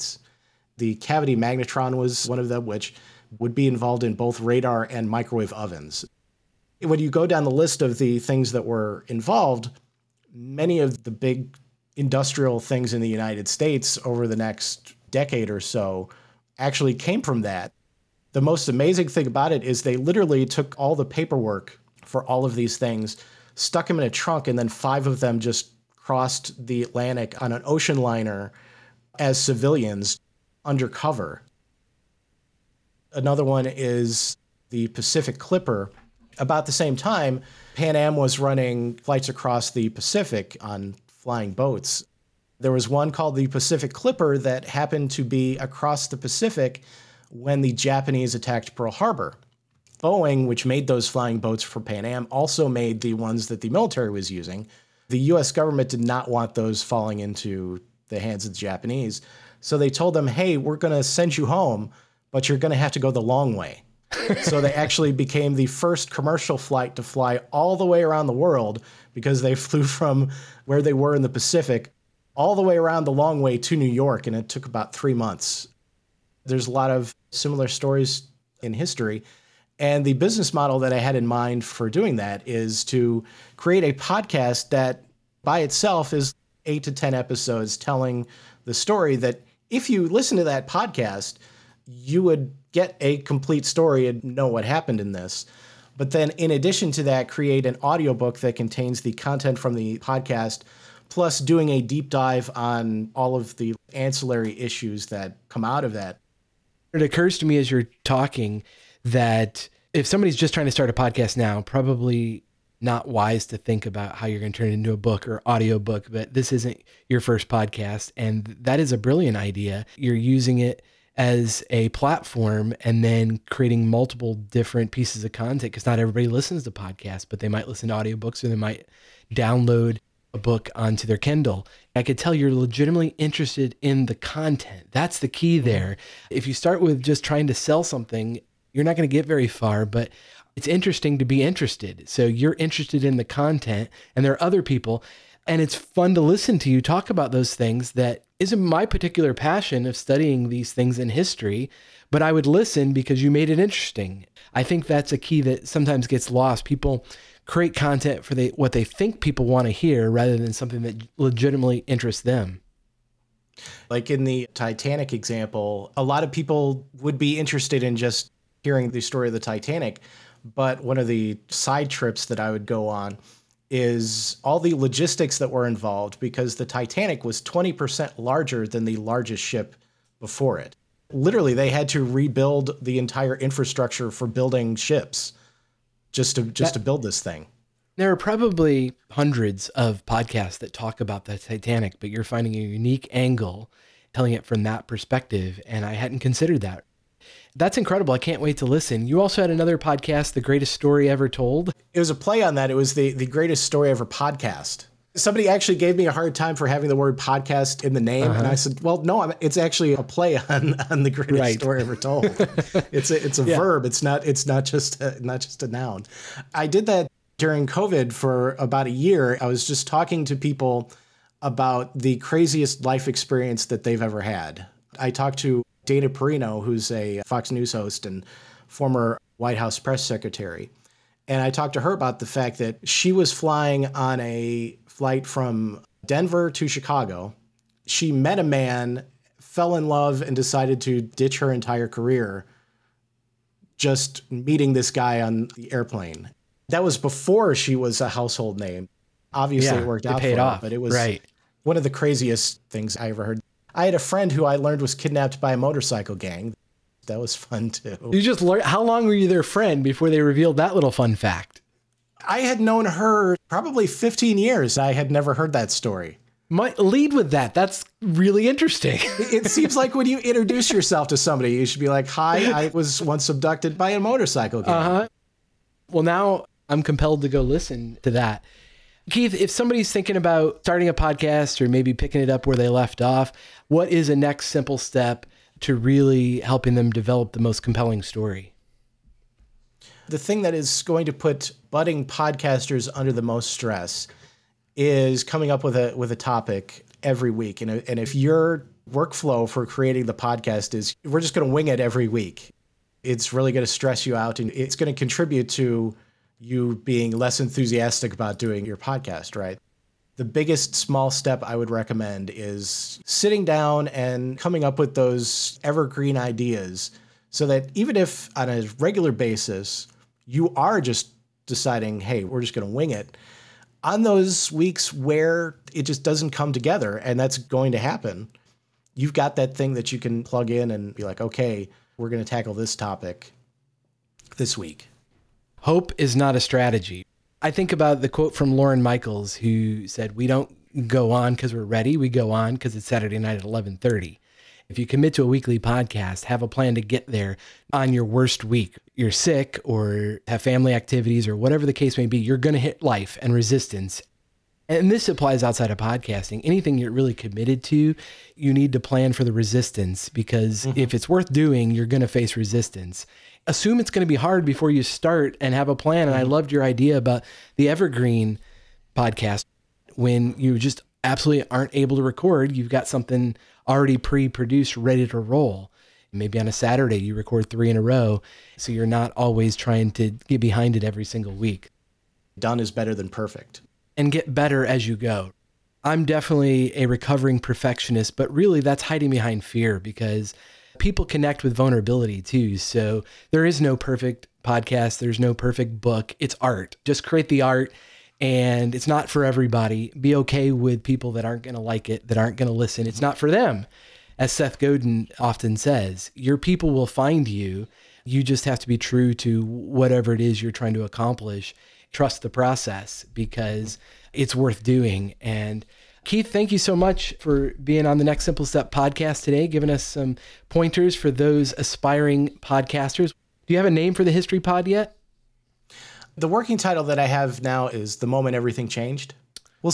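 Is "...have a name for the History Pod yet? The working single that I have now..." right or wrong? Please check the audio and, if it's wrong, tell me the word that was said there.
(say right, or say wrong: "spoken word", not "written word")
wrong: "title", not "single".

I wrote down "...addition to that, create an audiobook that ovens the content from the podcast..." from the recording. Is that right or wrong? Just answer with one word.
wrong.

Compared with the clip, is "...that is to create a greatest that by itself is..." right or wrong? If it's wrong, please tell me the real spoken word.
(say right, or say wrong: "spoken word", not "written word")
wrong: "podcast", not "greatest".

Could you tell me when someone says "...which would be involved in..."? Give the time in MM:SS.
00:02.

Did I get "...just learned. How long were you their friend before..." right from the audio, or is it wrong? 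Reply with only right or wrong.
right.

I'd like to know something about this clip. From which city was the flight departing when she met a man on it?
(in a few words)
Denver.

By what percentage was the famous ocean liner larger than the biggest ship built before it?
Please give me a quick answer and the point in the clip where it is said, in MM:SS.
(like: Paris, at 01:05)
20%, at 02:57.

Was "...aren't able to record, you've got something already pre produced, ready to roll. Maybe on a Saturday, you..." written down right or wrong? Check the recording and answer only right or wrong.
right.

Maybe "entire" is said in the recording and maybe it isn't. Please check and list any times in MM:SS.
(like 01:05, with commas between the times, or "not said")
03:02, 04:01.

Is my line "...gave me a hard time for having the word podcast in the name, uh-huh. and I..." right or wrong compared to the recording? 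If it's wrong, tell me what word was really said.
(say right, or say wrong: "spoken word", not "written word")
right.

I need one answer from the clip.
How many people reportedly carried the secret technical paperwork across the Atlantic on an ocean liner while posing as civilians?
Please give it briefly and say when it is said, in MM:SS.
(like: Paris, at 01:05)
5, at 00:24.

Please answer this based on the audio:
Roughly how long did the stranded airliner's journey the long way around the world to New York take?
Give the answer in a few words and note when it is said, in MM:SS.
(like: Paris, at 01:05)
3 months, at 01:14.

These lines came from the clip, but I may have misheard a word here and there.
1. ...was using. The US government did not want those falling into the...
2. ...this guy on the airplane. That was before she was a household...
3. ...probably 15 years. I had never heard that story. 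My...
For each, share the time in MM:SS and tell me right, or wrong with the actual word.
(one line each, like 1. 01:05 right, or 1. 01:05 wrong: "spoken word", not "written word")
1. 00:54 right
2. 04:04 right
3. 04:23 right.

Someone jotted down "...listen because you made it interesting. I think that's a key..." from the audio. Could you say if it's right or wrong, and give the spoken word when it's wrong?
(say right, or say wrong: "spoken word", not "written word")
right.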